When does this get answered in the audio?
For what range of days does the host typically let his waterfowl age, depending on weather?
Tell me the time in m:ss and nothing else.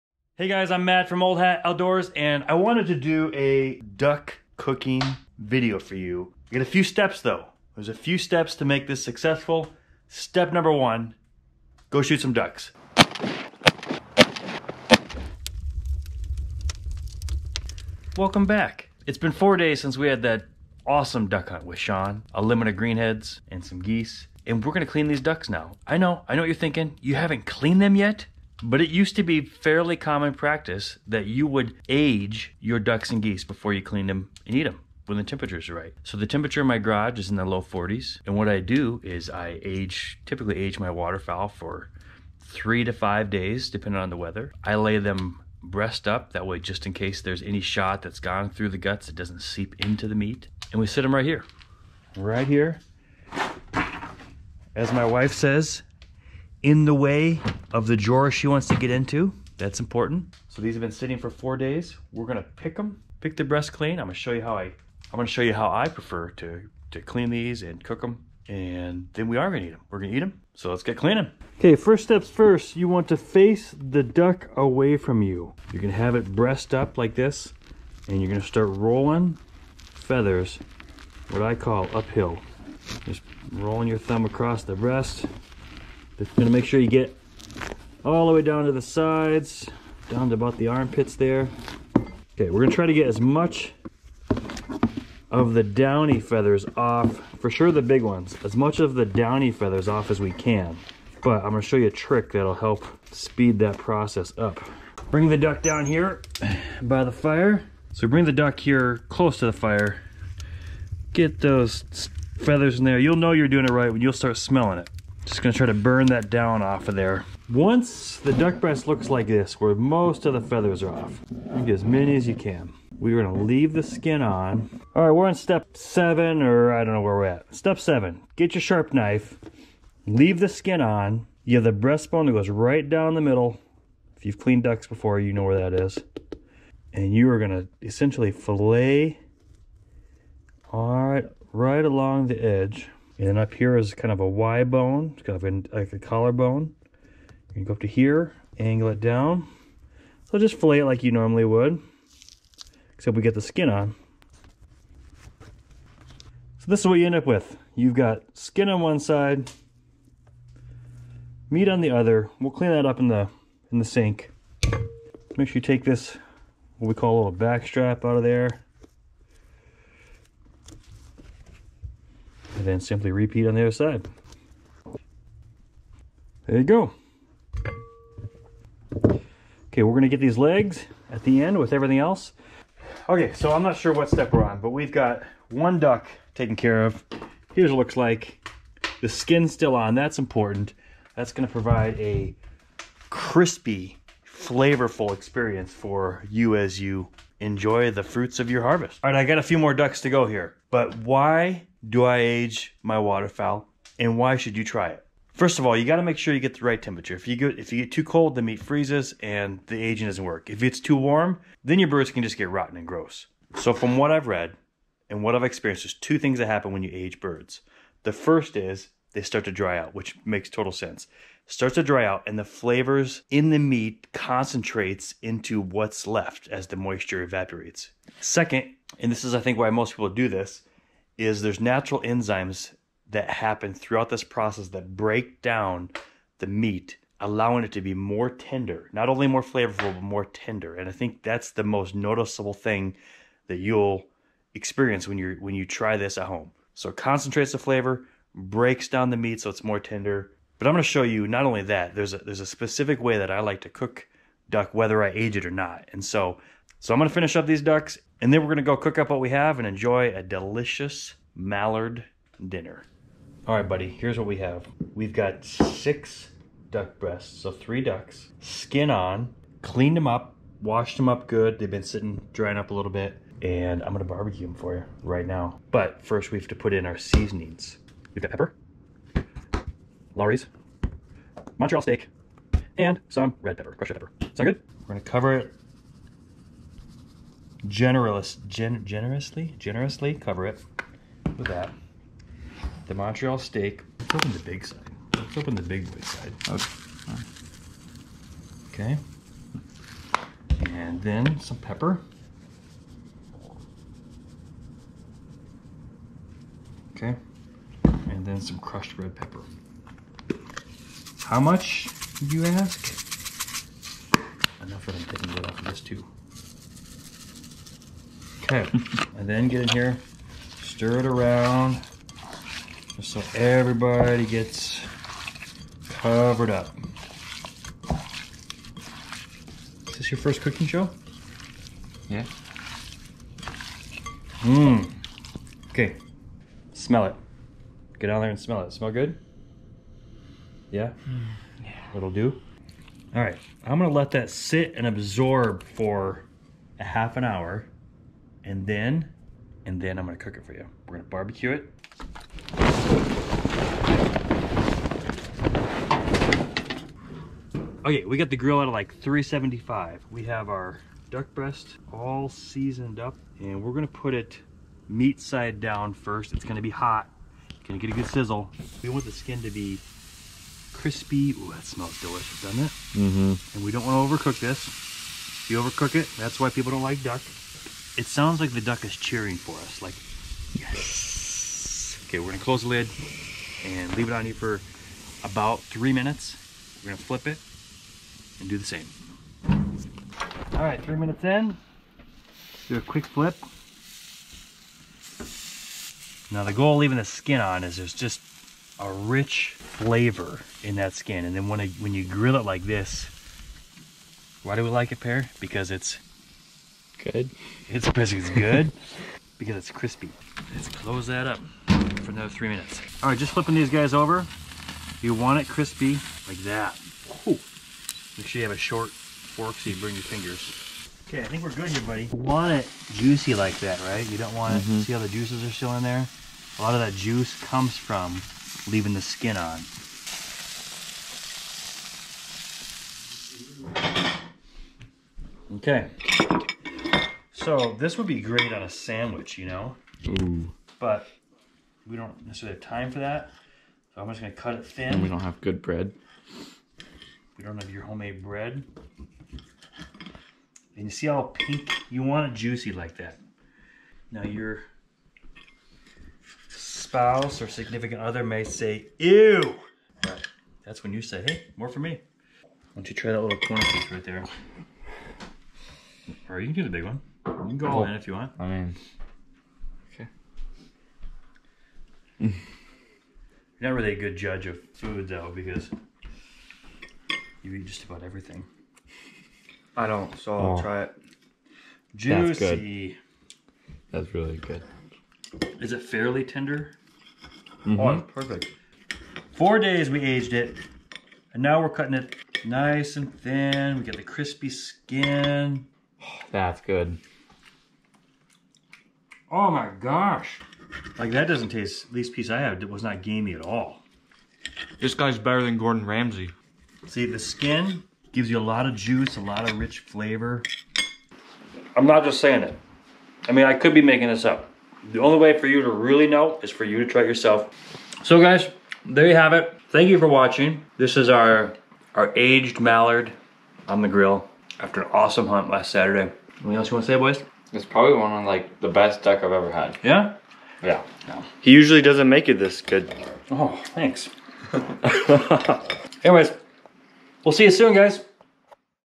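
0:42.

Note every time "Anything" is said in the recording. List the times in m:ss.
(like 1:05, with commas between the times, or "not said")
8:46.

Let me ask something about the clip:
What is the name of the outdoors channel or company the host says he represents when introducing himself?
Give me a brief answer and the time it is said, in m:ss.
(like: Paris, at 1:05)
Old Hat Outdoors, at 0:01.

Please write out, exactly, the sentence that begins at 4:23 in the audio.
All right, buddy, here's what we have.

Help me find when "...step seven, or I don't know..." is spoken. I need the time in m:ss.
2:05.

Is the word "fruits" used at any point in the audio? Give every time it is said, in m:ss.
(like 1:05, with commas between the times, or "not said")
3:18.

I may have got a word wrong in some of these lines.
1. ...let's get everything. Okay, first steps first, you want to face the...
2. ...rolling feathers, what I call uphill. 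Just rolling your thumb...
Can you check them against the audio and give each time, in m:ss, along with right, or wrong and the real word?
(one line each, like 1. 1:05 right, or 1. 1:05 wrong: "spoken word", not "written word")
1. 1:10 wrong: "cleaning", not "everything"
2. 1:18 right.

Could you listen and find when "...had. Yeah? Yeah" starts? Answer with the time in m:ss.
8:49.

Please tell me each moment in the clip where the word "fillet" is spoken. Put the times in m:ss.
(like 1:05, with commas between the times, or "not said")
2:18, 2:30.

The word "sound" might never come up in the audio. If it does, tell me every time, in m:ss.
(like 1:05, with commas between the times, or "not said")
4:44, 6:18.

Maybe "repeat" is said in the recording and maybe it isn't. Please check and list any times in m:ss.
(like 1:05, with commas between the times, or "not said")
2:53.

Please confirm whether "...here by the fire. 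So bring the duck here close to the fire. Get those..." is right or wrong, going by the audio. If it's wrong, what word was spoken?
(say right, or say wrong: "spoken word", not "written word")
right.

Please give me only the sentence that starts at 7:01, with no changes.
Okay, I think we're good here, buddy.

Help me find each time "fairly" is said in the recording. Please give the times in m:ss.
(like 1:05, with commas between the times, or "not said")
0:29, 8:05.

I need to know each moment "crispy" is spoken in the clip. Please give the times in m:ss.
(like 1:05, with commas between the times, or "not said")
3:13, 6:10, 6:49, 6:55, 8:14.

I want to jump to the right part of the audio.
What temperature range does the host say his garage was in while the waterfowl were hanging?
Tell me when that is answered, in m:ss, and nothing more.
0:37.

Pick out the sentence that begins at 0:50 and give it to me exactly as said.
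And we sit them right here, right here.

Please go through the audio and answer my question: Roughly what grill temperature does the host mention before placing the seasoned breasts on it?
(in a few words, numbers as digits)
375.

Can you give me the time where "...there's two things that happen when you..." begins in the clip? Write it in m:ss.
3:35.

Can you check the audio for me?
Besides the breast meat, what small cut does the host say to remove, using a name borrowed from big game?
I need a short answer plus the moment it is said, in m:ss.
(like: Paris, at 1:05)
back strap, at 2:47.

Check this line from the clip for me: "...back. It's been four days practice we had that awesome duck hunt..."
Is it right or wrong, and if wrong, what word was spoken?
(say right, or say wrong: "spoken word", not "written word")
wrong: "since", not "practice".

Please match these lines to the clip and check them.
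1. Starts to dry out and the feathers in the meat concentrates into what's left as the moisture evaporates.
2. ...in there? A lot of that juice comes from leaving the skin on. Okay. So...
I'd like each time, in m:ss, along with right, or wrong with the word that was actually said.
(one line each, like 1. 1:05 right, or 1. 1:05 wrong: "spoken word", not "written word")
1. 3:41 wrong: "flavors", not "feathers"
2. 7:05 right.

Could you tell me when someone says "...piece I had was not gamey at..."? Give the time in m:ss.
8:22.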